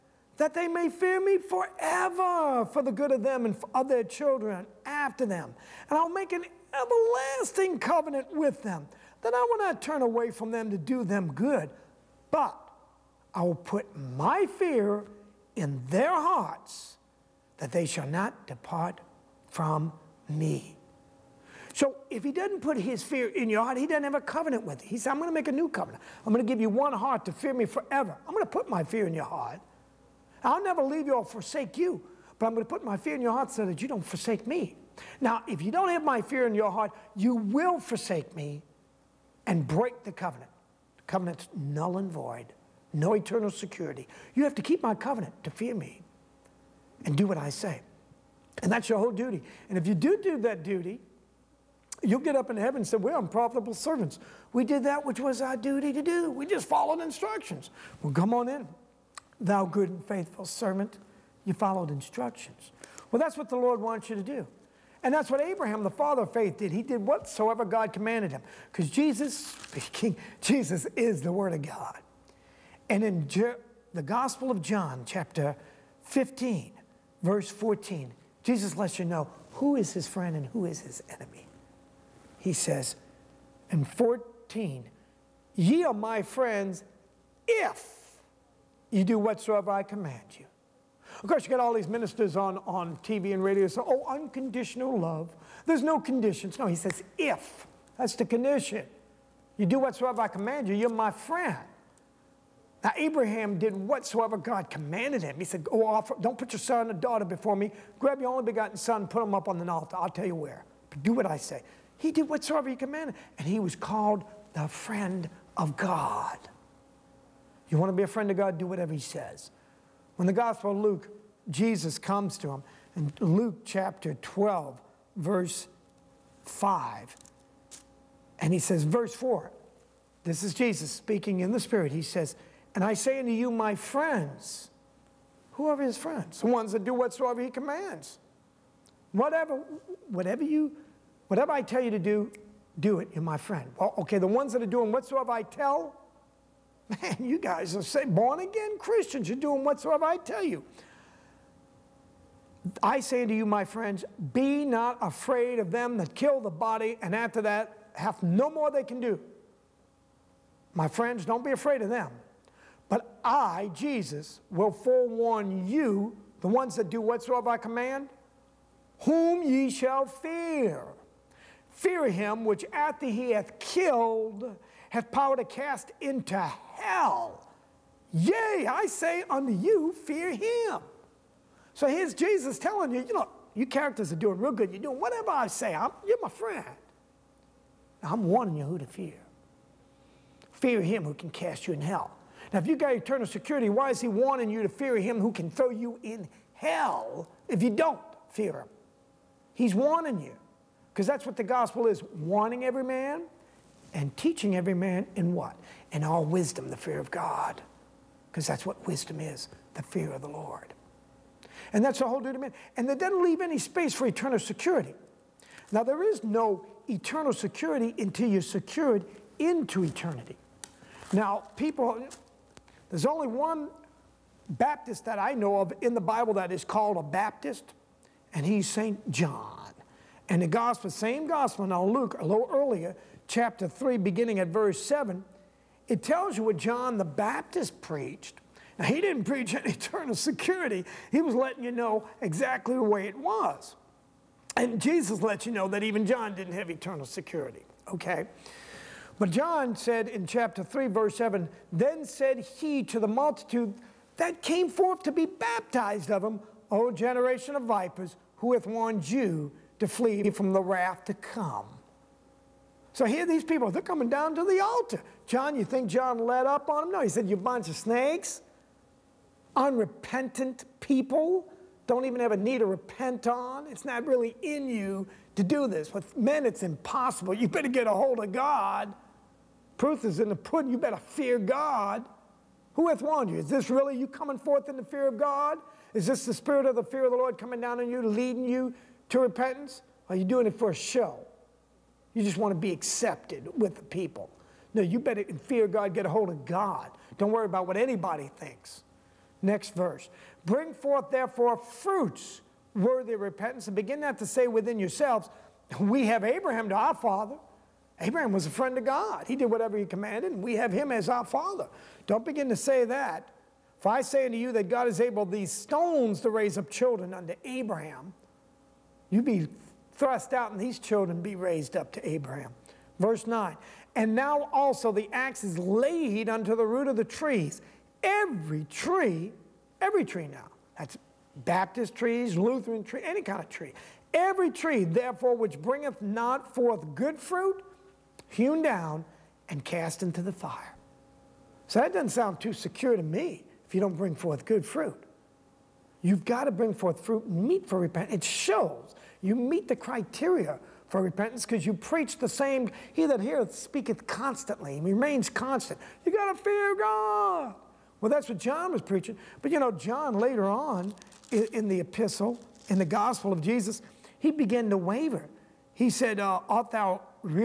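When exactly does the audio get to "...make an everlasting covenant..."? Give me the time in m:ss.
0:06.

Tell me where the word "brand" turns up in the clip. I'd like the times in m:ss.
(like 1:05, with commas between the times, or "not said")
not said.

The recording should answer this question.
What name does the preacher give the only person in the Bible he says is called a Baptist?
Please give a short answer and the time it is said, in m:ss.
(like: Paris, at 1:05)
St. John, at 3:48.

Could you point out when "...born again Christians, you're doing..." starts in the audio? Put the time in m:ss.
2:28.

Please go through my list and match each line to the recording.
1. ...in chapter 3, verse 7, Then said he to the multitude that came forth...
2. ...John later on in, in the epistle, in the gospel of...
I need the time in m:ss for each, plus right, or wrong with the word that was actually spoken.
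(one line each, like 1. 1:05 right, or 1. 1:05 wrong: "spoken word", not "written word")
1. 4:10 right
2. 5:59 right.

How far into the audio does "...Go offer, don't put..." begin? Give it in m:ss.
1:45.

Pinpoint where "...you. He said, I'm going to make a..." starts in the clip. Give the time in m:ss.
0:24.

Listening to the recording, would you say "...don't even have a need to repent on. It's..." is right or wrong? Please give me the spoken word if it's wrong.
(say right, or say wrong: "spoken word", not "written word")
right.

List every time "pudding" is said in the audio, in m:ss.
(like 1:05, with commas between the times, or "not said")
4:40.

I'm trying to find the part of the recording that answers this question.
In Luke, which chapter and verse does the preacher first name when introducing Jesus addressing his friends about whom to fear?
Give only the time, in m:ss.
2:03.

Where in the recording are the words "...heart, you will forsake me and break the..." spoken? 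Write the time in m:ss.
0:36.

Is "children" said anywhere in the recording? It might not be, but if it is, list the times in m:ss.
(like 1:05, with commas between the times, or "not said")
0:04, 5:16, 5:20.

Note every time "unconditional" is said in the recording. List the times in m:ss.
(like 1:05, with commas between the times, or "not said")
1:34.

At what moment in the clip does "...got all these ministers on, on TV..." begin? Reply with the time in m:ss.
1:31.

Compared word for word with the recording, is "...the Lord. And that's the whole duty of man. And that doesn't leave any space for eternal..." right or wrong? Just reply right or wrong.
right.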